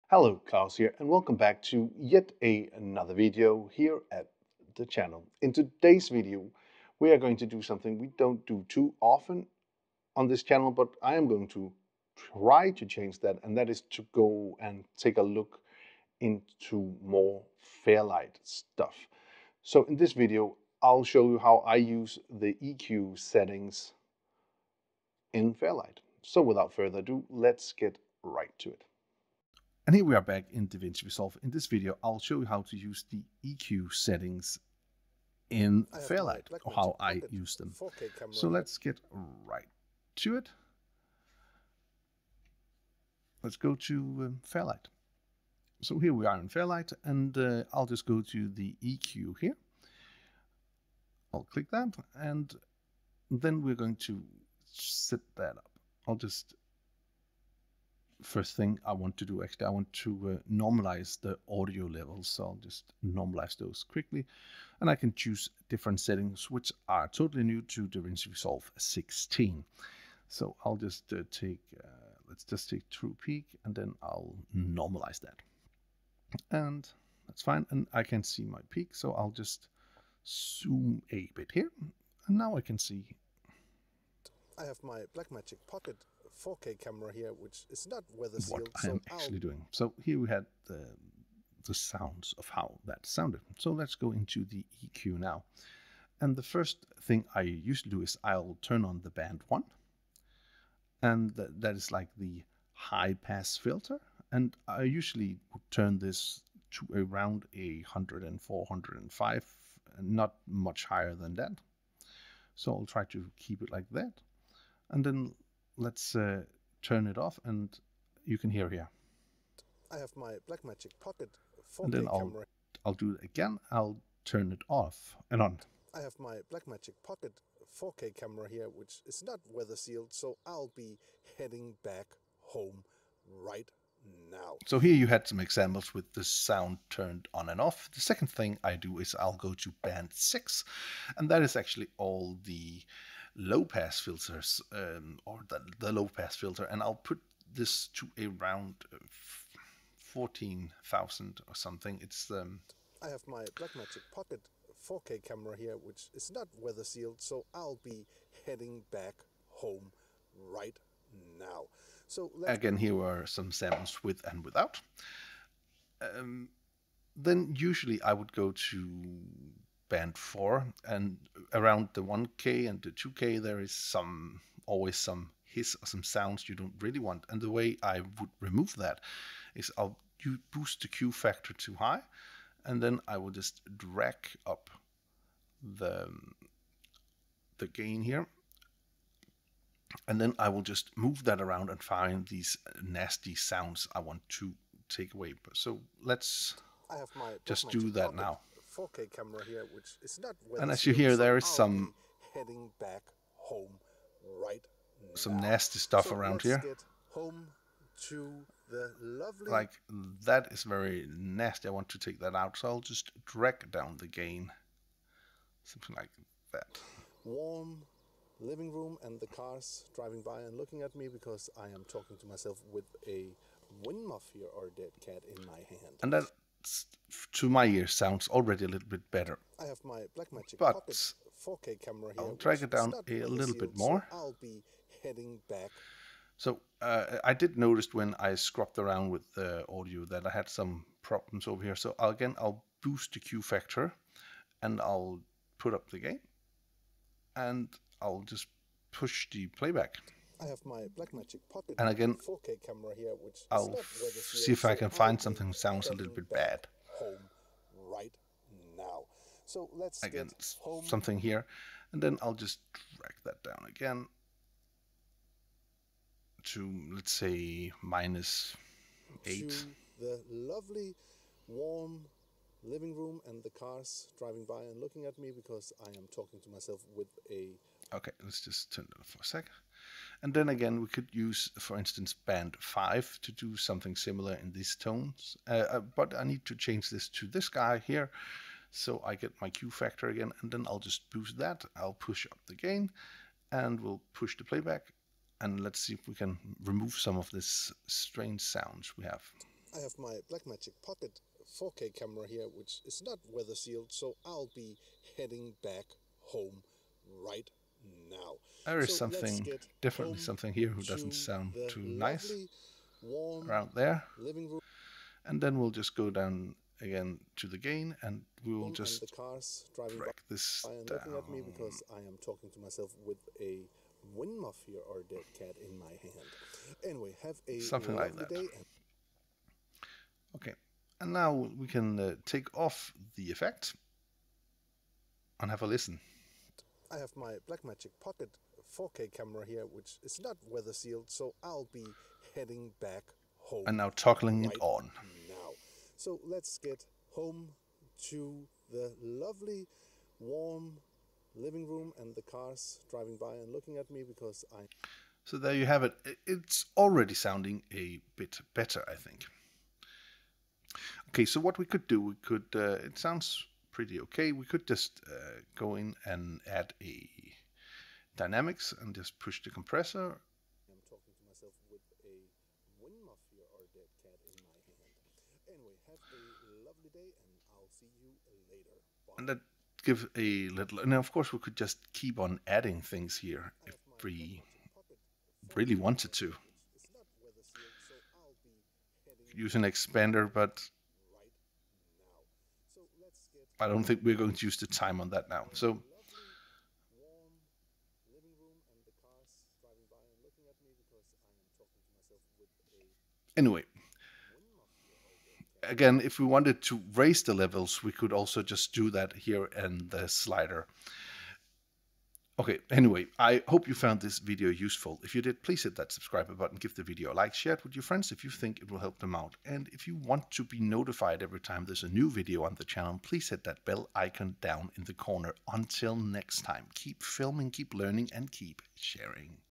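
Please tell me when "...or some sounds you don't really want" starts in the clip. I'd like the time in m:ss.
2:55.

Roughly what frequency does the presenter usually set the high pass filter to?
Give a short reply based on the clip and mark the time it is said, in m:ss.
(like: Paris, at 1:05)
104, at 1:47.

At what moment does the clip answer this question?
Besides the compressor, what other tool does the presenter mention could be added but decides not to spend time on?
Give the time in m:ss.
6:29.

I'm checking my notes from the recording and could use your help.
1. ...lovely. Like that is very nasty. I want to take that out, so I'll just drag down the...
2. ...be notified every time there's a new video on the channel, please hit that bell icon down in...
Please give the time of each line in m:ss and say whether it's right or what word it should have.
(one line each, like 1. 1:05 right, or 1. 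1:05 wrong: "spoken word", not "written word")
1. 3:29 right
2. 7:00 right.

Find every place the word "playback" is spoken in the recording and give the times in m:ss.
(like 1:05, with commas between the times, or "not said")
4:09, 4:54.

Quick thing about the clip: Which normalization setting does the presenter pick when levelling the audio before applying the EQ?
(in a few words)
true peak.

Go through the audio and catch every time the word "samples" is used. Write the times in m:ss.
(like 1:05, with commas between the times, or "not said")
2:43.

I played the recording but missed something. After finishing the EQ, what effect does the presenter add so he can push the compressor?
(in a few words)
dynamics.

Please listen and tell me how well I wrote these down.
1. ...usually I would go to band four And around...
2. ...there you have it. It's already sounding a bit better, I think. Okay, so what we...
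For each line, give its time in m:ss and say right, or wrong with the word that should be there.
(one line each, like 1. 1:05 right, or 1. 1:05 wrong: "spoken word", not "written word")
1. 2:47 right
2. 5:55 right.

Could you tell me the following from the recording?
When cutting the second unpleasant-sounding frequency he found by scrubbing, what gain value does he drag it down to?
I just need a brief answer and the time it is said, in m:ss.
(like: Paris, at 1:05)
-8, at 4:27.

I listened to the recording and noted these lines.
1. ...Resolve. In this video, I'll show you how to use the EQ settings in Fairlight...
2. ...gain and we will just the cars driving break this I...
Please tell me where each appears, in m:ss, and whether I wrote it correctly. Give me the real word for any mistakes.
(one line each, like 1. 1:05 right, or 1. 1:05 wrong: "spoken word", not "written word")
1. 0:31 right
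2. 5:17 right.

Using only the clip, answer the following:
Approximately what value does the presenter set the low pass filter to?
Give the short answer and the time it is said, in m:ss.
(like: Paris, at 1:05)
14000, at 2:29.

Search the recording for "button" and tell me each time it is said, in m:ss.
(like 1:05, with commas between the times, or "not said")
6:56.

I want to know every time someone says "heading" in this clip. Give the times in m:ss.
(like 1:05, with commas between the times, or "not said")
2:11, 2:38, 3:22, 3:55, 5:05, 5:42.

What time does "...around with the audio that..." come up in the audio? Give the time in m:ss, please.
3:58.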